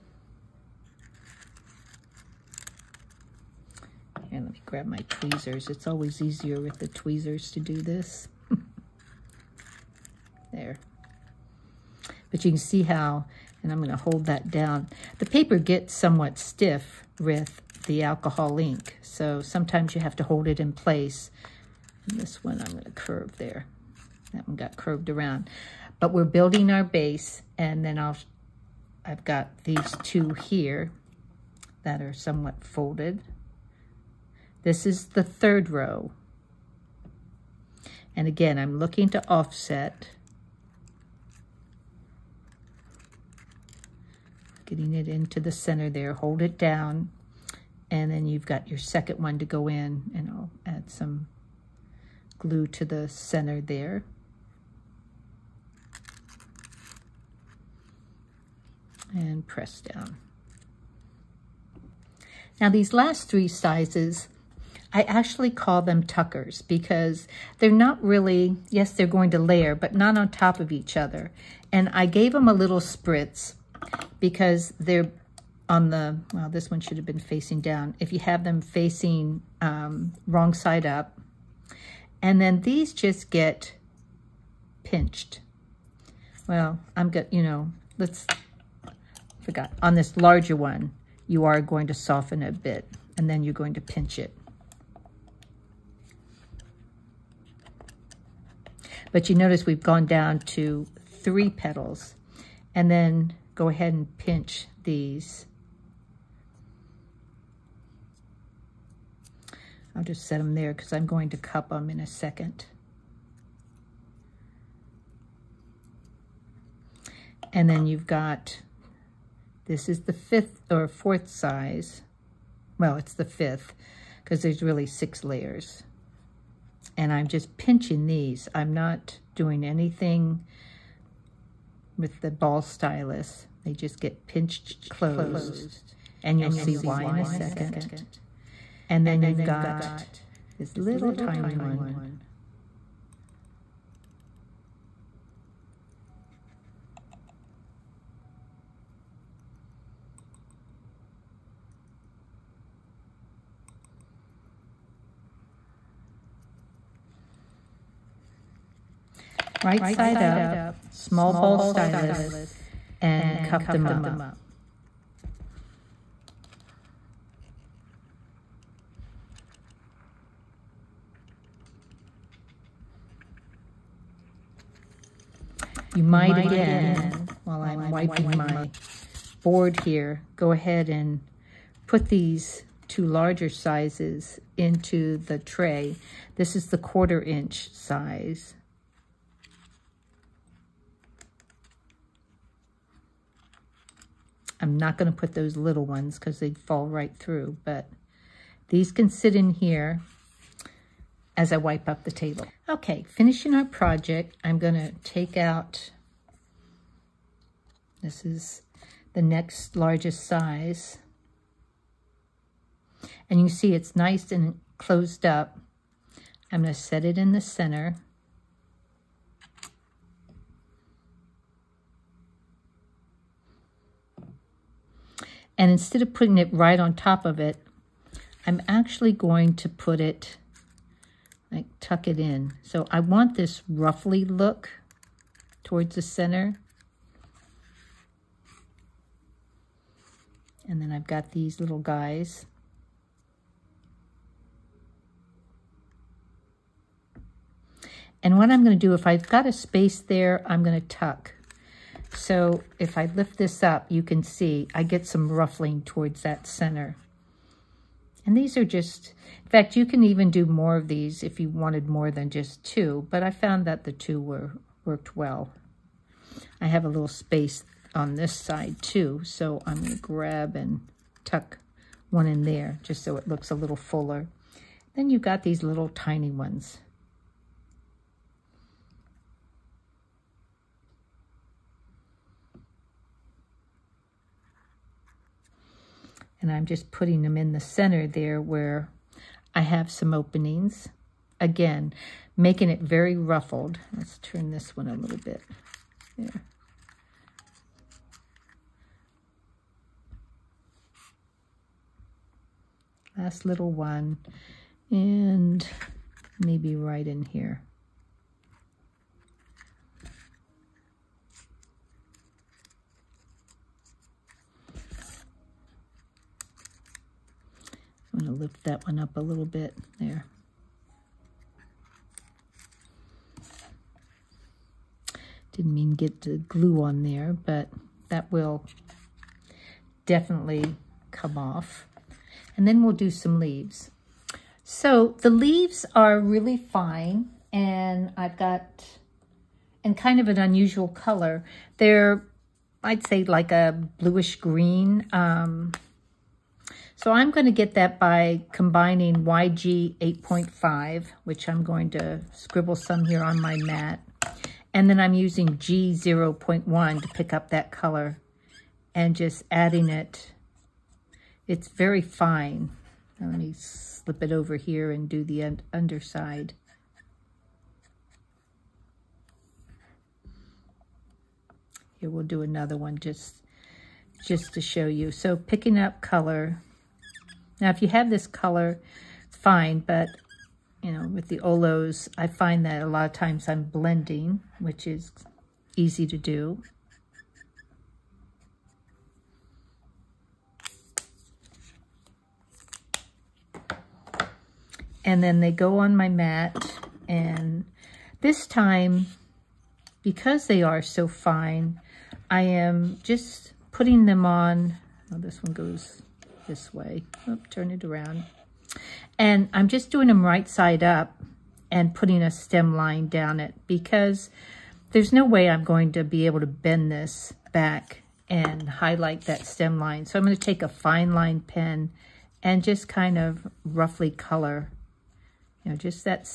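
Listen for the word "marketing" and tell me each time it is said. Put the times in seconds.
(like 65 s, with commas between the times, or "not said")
not said.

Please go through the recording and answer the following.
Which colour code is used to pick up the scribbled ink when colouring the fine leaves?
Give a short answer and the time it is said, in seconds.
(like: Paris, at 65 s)
G 0.1, at 355 s.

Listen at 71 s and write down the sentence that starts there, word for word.
And I gave them a little spritz because they're on the, well, this one should have been facing down.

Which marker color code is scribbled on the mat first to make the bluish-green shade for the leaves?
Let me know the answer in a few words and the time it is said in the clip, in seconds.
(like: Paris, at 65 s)
YG 8.5, at 349 s.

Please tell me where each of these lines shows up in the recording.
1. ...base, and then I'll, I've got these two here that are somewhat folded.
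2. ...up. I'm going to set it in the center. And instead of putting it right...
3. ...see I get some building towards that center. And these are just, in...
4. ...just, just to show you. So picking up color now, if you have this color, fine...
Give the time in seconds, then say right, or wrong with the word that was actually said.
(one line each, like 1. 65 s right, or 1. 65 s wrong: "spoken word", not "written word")
1. 26 s right
2. 215 s right
3. 254 s wrong: "ruffling", not "building"
4. 372 s right.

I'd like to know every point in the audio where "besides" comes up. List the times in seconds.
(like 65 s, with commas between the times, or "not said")
not said.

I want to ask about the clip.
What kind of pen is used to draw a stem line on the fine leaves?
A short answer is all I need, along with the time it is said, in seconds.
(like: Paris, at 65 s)
Fine line pen, at 420 s.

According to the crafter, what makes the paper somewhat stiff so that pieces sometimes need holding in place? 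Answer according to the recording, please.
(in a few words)
Alcohol ink.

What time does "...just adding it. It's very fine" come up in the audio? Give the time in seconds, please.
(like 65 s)
359 s.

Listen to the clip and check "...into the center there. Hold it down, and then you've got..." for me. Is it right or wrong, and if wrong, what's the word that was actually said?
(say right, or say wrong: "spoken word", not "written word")
right.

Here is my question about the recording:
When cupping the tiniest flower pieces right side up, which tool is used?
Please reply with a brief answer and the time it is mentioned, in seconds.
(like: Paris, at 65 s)
Small ball stylus, at 160 s.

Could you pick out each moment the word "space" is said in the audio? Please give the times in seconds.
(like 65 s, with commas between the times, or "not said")
249 s, 267 s.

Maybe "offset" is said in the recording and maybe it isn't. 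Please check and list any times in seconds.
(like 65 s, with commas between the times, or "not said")
39 s.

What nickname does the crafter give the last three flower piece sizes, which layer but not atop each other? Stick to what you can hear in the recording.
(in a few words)
Tuckers.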